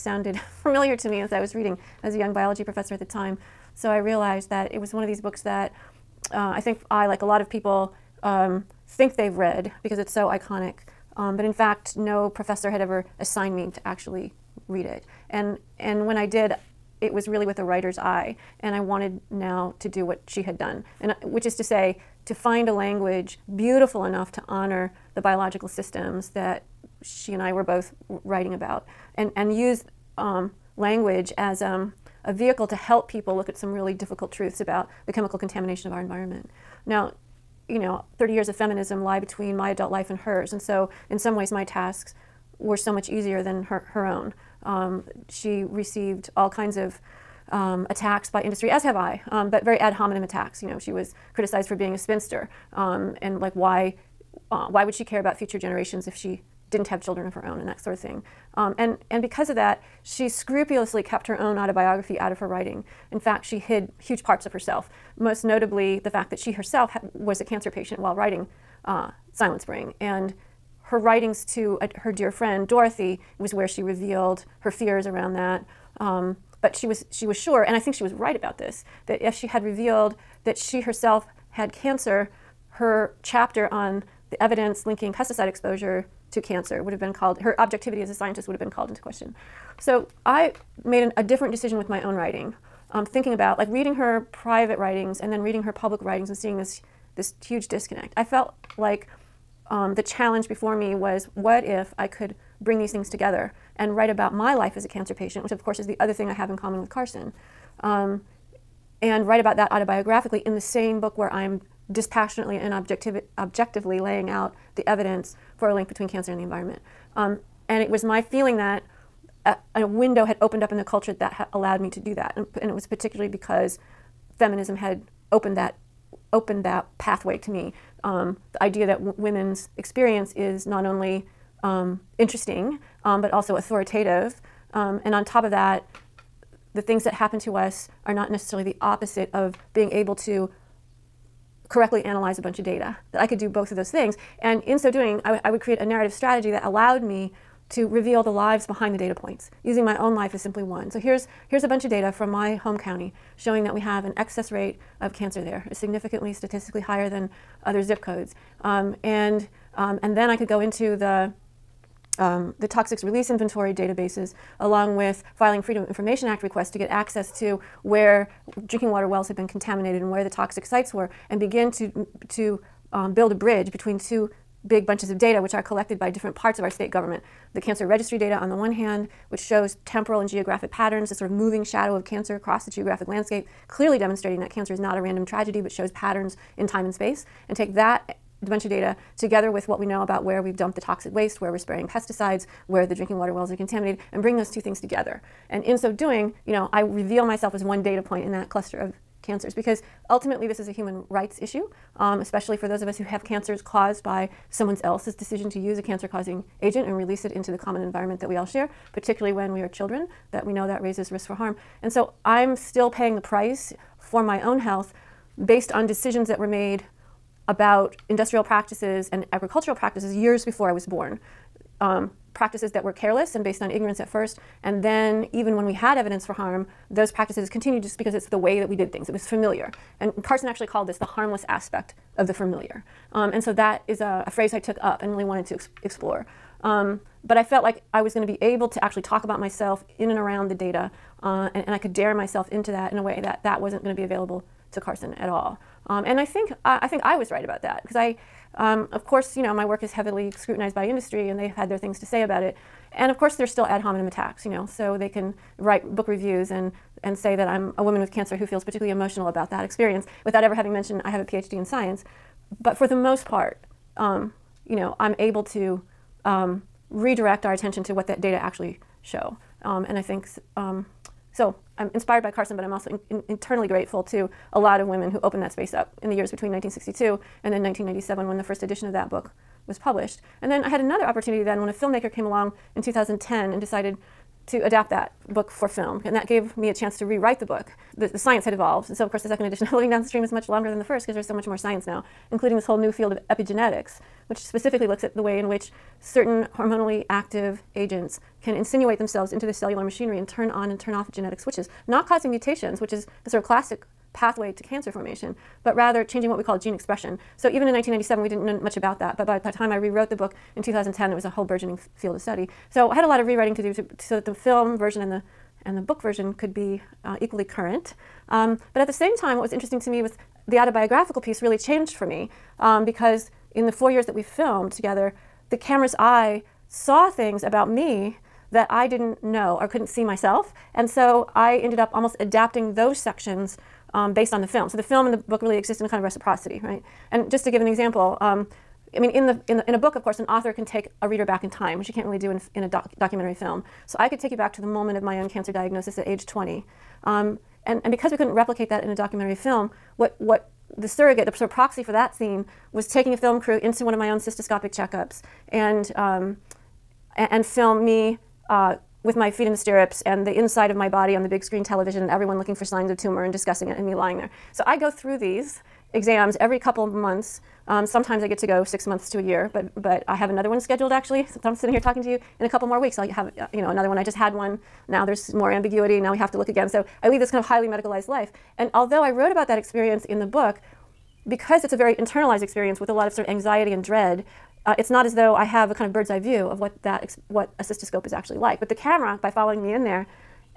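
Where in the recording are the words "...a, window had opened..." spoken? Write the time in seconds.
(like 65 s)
119 s.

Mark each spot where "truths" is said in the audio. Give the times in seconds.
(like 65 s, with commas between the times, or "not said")
34 s.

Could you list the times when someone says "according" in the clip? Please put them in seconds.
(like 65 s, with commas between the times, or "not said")
not said.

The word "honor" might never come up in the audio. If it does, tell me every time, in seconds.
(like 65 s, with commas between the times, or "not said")
24 s.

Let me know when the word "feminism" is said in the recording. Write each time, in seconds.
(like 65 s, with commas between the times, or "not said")
38 s, 124 s.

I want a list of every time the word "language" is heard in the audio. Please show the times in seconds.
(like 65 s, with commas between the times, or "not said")
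22 s, 30 s.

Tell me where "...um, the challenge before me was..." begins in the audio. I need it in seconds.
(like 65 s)
99 s.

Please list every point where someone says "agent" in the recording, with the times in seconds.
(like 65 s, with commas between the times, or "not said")
206 s, 297 s.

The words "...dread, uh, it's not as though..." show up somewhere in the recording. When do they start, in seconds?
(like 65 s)
383 s.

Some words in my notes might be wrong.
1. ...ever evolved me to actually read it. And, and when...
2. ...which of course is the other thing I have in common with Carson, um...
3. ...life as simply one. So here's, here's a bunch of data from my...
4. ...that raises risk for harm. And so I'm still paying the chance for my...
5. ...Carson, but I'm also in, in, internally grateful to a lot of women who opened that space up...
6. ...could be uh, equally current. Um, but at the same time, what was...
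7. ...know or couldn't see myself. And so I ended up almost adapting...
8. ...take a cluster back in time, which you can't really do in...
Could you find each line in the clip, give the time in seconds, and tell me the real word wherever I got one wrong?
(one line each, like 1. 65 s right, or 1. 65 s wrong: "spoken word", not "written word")
1. 12 s wrong: "assigned", not "evolved"
2. 105 s right
3. 150 s right
4. 210 s wrong: "price", not "chance"
5. 272 s right
6. 316 s right
7. 329 s right
8. 340 s wrong: "reader", not "cluster".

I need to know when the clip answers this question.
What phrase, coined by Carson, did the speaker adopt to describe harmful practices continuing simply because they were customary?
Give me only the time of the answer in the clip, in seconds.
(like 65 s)
230 s.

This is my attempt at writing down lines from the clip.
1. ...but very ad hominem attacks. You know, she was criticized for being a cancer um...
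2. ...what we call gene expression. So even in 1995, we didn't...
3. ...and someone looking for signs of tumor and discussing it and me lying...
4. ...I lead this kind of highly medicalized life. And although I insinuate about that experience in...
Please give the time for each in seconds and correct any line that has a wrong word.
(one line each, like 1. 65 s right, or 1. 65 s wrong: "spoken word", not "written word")
1. 49 s wrong: "spinster", not "cancer"
2. 306 s wrong: "1997", not "1995"
3. 362 s wrong: "everyone", not "someone"
4. 377 s wrong: "wrote", not "insinuate".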